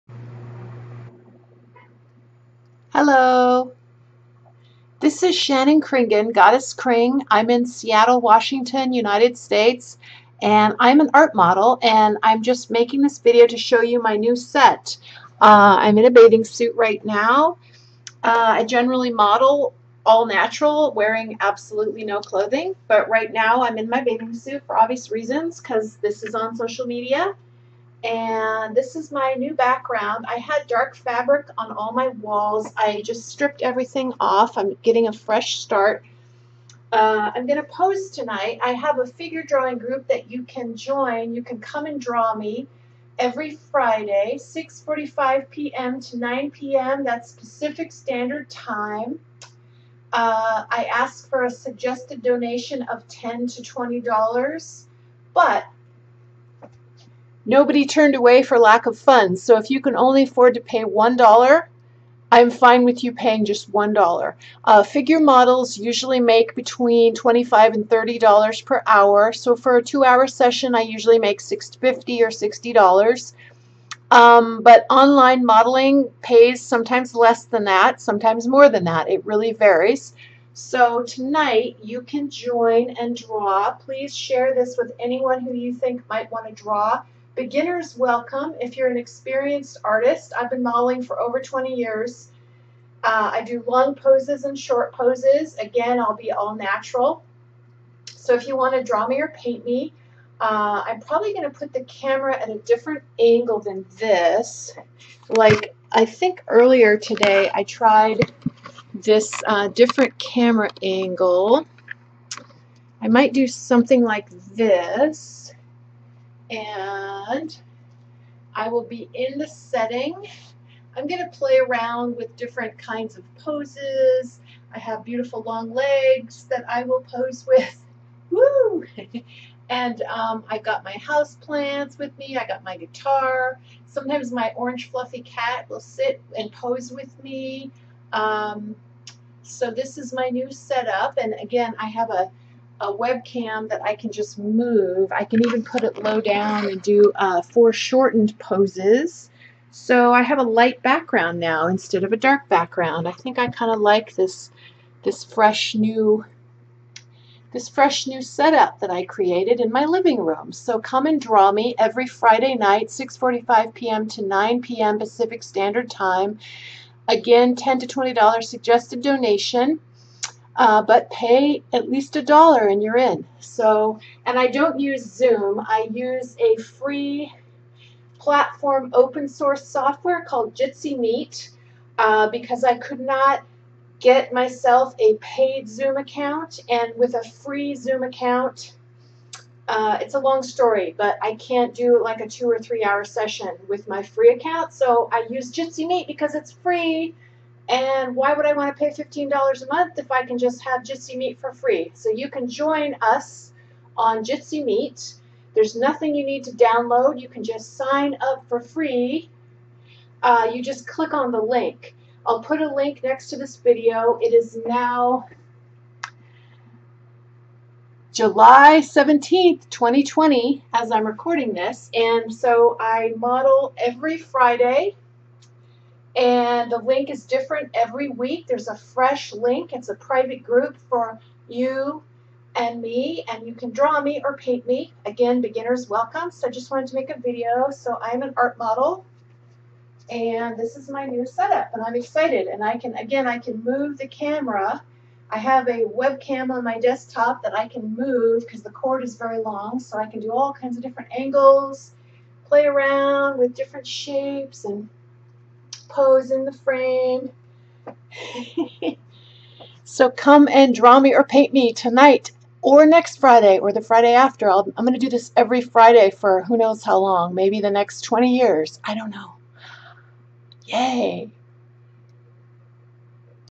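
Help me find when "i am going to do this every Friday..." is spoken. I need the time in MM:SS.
04:24.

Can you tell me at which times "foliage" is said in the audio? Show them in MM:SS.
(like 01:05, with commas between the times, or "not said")
not said.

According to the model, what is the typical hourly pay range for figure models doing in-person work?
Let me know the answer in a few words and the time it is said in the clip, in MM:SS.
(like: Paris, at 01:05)
$25 to $30, at 01:06.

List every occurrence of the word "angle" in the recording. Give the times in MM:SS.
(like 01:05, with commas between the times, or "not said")
01:43, 01:50, 04:11.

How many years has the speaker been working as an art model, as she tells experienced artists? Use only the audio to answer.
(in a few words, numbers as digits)
over 20 years.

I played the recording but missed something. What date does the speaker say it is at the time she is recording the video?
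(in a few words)
July 17th, 2020.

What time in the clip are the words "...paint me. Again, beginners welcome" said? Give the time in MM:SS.
03:54.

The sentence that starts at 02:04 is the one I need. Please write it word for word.
I have beautiful long legs that I will pose with.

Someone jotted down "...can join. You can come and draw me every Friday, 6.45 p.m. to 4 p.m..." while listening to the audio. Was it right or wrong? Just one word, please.
wrong.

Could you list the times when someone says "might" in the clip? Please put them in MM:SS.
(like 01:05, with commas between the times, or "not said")
01:26, 01:53.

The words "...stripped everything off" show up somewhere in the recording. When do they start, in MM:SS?
00:33.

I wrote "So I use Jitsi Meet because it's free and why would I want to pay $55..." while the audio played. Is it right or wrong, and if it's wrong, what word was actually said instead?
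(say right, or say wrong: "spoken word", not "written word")
wrong: "15", not "55".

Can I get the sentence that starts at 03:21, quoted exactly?
So you can join us on Jitsi Meet.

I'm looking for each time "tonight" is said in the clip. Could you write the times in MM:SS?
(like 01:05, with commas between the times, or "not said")
00:38, 01:21, 04:21.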